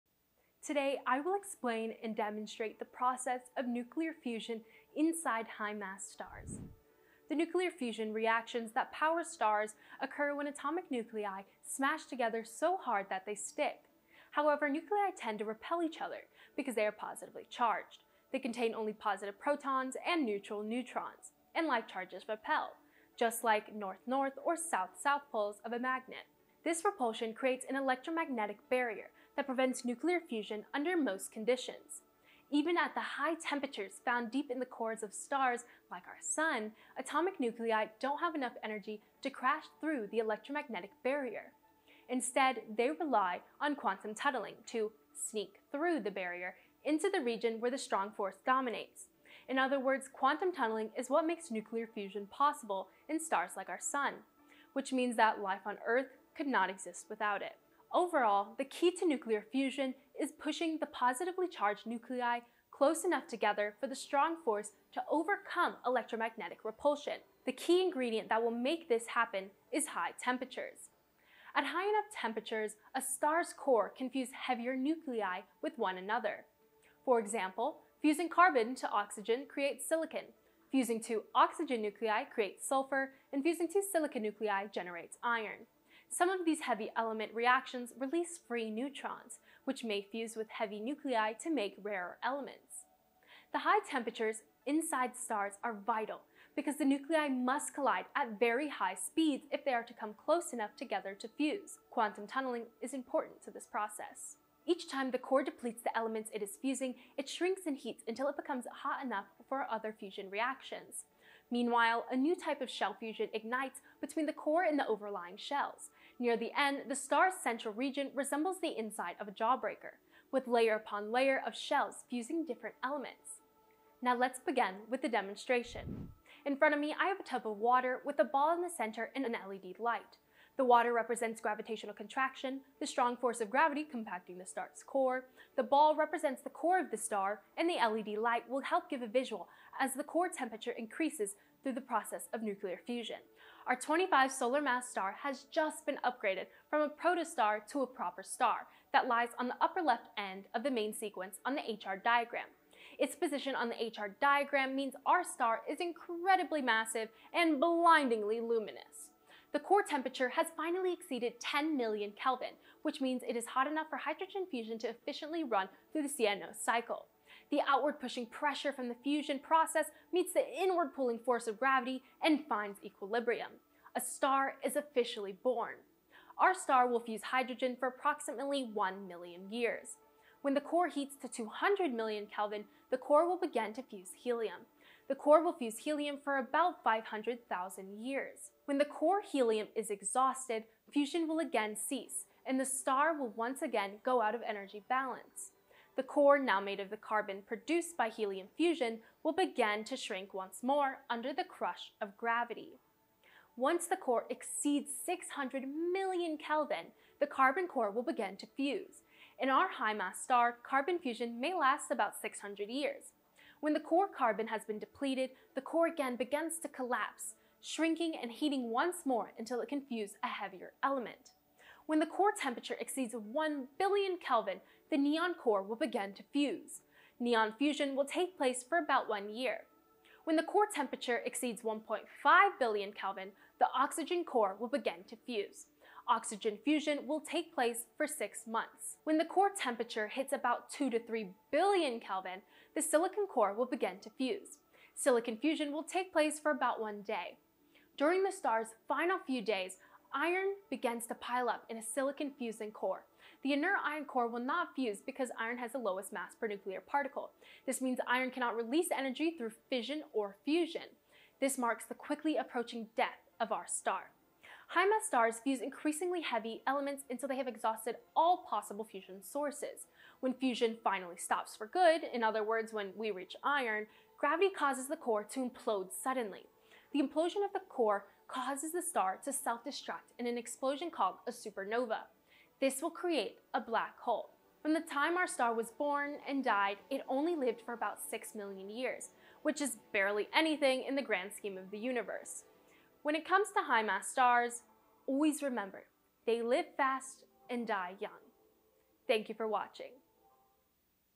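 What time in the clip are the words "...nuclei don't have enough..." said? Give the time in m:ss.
0:37.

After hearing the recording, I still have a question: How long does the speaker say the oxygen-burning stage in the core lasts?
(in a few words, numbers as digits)
Six months.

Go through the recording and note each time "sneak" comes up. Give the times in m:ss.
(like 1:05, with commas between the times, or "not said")
0:45.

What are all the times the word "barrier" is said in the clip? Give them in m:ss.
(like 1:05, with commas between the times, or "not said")
0:28, 0:41, 0:46.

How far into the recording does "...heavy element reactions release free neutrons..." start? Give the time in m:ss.
1:26.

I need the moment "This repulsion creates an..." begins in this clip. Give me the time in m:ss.
0:26.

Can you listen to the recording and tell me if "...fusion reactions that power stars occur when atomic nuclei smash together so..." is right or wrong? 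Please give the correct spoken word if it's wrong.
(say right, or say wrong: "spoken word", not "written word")
right.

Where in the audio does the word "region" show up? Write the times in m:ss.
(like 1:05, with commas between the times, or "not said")
0:47, 1:57.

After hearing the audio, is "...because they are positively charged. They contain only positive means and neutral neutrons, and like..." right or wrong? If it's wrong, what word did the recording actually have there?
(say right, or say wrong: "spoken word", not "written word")
wrong: "protons", not "means".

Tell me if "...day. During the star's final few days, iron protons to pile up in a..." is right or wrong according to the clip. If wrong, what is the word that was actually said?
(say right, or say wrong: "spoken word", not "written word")
wrong: "begins", not "protons".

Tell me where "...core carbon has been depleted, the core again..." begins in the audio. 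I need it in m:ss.
3:33.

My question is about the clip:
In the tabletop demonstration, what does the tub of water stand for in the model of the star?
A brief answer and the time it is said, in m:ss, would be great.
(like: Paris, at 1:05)
Gravitational contraction, at 2:11.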